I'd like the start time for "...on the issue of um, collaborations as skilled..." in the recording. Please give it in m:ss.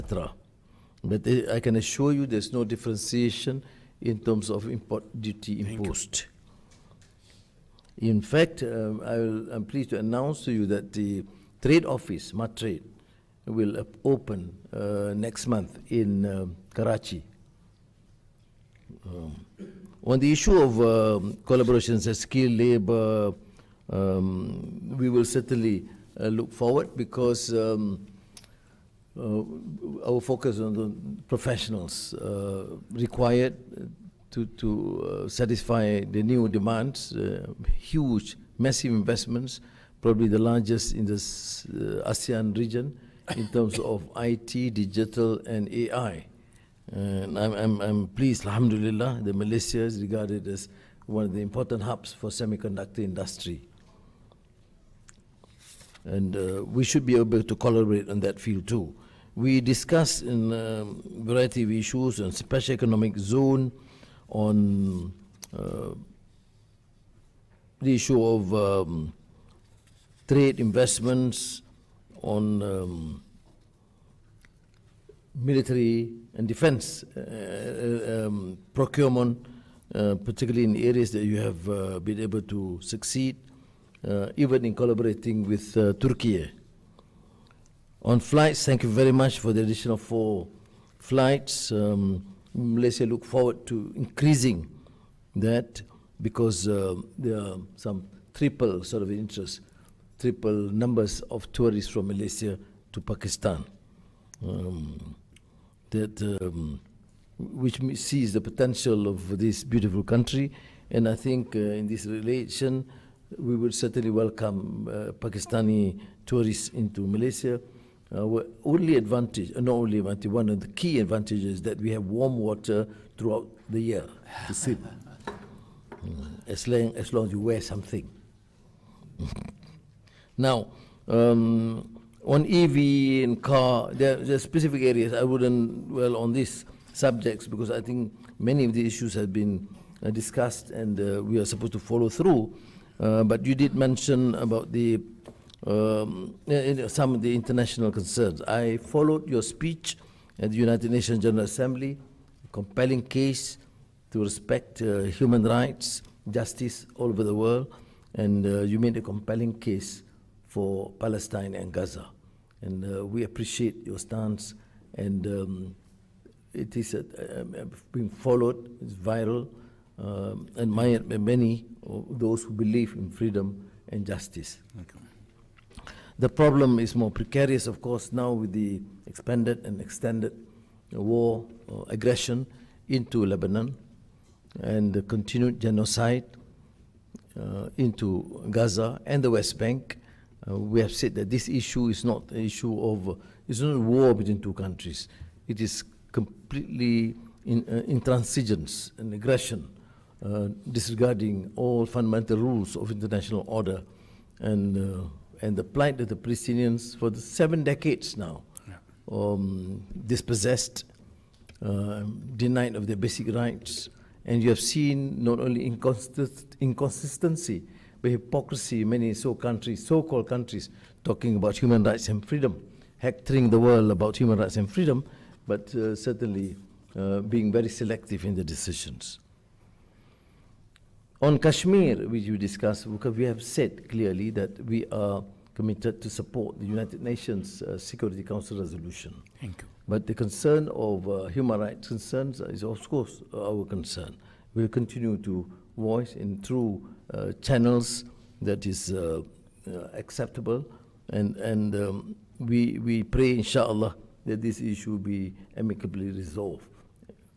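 0:20.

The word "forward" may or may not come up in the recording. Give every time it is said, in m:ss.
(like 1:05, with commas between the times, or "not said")
0:26, 1:33.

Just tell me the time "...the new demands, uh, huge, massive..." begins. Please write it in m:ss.
0:36.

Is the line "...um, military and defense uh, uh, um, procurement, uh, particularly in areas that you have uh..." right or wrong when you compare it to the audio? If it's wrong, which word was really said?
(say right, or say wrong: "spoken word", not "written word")
right.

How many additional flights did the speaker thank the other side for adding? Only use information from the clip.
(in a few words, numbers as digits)
4.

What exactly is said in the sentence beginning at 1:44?
Um, that um, which sees the potential of this beautiful country.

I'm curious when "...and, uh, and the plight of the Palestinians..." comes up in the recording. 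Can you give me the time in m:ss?
3:24.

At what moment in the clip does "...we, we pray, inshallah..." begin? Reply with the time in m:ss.
4:12.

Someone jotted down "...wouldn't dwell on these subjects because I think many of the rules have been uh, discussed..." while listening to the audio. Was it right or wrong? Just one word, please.
wrong.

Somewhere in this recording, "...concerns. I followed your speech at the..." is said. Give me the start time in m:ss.
2:27.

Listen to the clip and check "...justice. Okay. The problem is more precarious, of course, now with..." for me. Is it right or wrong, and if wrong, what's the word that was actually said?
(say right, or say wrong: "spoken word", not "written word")
right.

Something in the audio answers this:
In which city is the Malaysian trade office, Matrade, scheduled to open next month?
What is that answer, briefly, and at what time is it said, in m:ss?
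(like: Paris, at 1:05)
Karachi, at 0:16.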